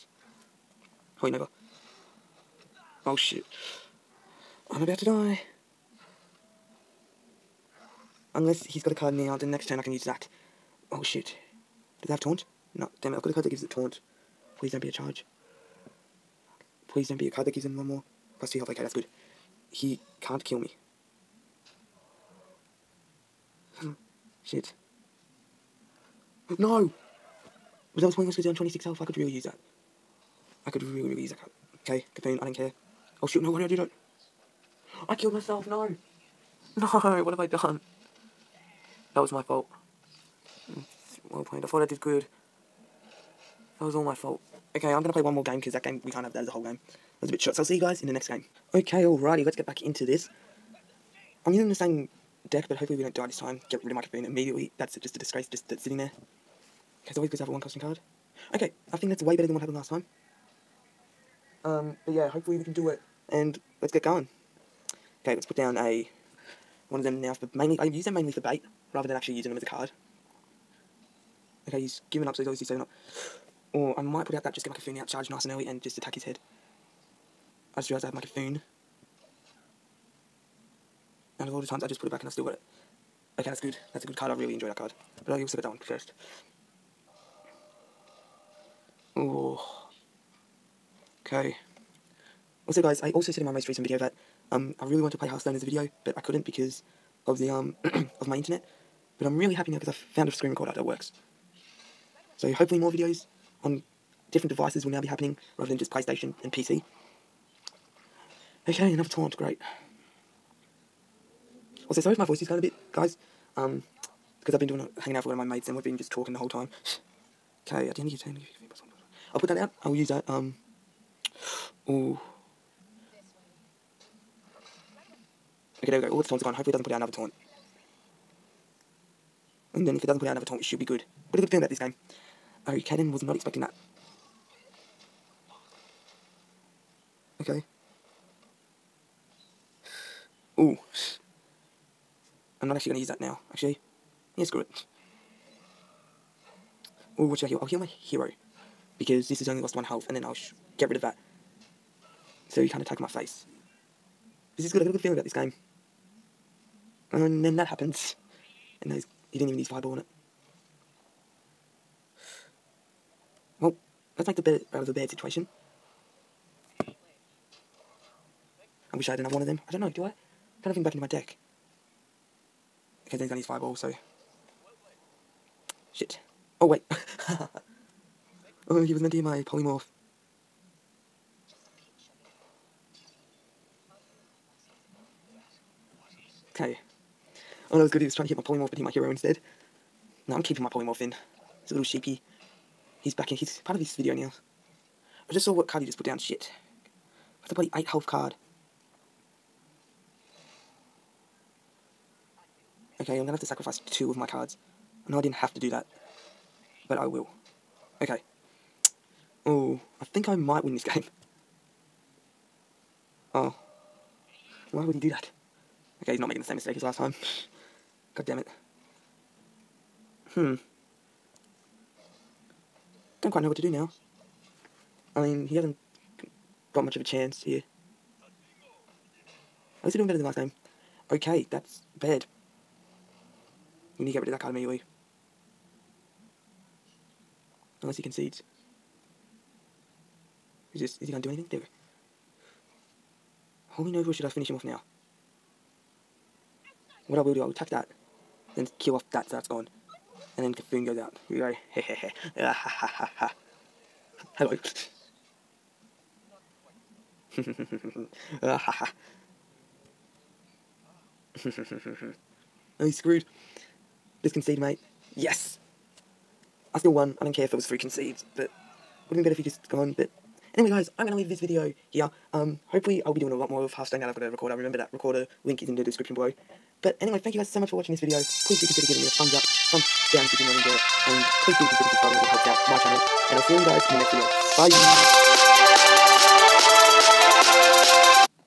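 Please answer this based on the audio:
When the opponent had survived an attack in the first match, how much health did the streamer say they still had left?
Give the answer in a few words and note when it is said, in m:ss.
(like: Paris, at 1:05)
26, at 0:28.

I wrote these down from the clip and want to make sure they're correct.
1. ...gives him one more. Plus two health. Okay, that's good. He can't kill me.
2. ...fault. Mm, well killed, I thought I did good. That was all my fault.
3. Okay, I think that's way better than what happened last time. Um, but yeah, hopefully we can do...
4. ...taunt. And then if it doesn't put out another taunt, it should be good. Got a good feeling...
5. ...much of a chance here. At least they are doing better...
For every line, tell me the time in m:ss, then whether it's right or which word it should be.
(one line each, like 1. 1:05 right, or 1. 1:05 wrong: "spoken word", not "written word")
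1. 0:17 right
2. 0:39 wrong: "played", not "killed"
3. 0:58 right
4. 2:07 right
5. 3:46 right.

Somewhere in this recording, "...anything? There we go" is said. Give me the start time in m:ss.
4:01.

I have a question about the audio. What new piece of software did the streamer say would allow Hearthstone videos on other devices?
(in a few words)
Screen recorder.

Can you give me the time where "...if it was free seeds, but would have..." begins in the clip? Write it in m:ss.
4:27.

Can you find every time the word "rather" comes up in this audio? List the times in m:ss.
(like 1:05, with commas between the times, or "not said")
1:08, 1:45.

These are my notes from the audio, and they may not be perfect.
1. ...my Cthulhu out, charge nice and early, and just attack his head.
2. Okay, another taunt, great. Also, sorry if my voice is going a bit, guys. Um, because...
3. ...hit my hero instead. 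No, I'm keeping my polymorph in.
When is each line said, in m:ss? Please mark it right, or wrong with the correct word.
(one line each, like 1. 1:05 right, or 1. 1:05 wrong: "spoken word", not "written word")
1. 1:14 right
2. 1:48 right
3. 3:08 right.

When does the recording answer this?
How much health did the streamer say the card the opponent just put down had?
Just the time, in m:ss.
3:17.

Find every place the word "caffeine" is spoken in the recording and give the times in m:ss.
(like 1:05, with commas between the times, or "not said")
0:32, 0:54.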